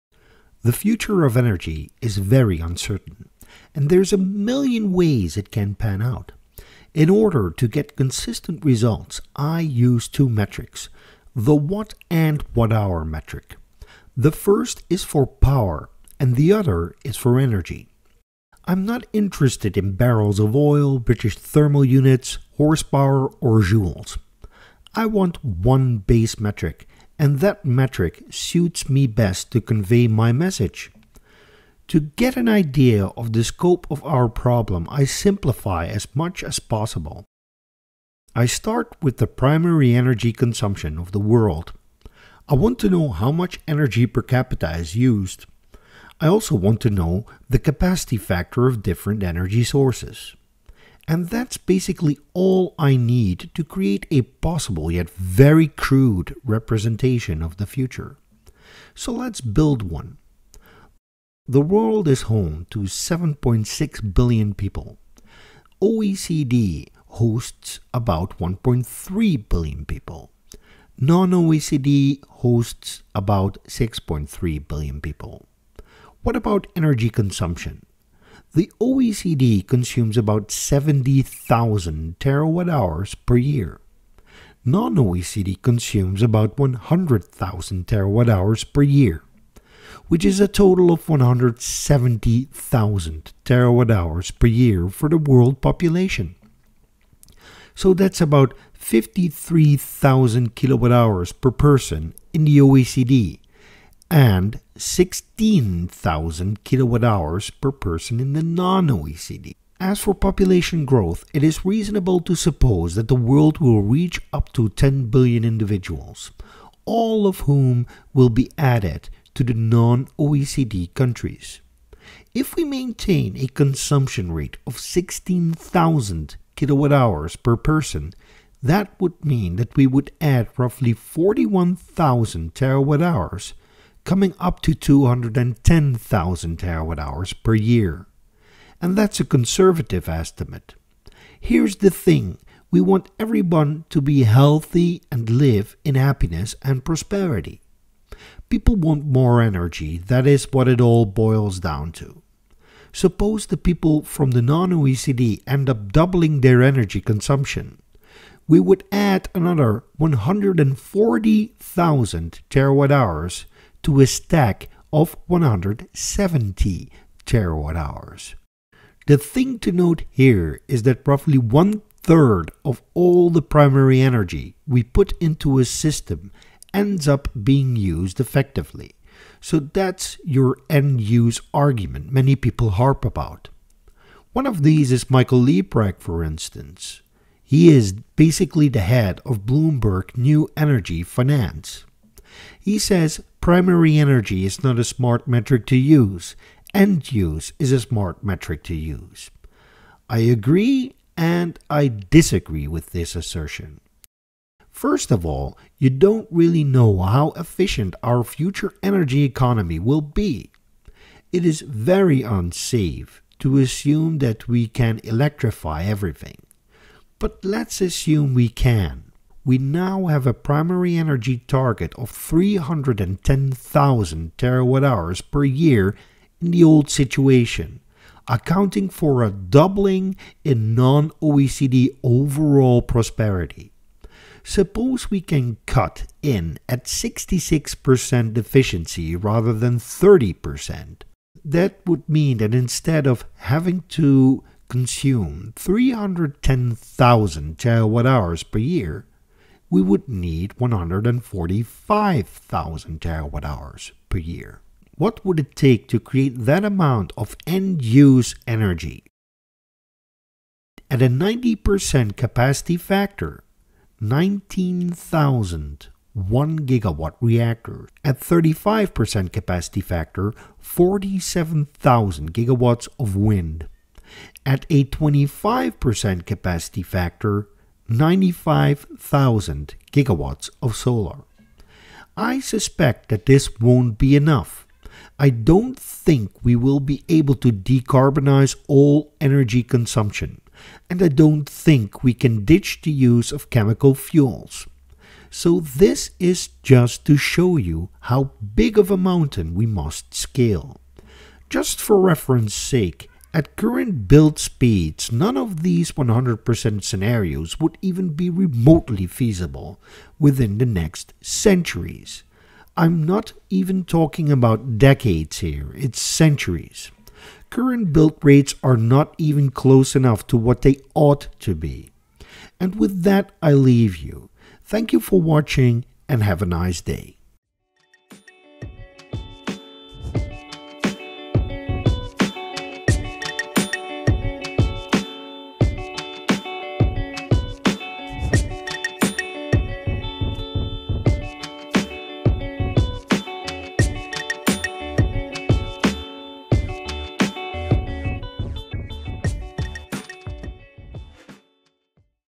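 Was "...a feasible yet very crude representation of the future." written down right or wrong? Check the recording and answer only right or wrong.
wrong.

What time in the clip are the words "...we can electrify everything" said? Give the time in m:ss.
3:34.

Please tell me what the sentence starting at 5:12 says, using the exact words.
I'm not even talking about decades here, it's centuries.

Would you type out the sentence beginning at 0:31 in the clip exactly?
To get an idea of the scope of our problem, I simplify as much as possible.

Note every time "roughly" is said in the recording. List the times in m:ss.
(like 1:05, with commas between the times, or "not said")
2:10, 2:51.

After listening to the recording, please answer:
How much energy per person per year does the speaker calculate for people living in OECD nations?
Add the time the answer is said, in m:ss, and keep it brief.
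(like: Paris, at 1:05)
53,000 kilowatt hours, at 1:38.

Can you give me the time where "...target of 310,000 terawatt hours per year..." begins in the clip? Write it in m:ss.
3:41.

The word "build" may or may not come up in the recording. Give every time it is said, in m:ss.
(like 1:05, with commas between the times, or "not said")
0:59, 5:04, 5:17.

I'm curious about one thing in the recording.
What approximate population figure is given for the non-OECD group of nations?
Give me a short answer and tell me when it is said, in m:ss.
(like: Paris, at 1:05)
6.3 billion, at 1:13.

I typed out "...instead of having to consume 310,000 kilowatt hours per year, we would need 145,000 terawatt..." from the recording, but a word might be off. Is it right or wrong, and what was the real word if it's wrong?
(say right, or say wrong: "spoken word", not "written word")
wrong: "terawatt", not "kilowatt".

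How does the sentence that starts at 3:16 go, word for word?
End use is a smart metric to use.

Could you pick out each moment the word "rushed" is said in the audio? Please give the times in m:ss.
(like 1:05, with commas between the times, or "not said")
not said.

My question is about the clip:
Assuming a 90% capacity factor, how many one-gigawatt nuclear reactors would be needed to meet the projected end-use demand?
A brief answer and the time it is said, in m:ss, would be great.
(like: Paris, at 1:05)
19,000, at 4:24.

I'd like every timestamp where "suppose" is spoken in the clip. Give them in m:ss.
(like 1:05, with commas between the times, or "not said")
1:52, 2:32, 3:54.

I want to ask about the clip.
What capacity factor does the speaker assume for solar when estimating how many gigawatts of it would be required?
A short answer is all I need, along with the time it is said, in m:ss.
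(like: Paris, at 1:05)
25%, at 4:34.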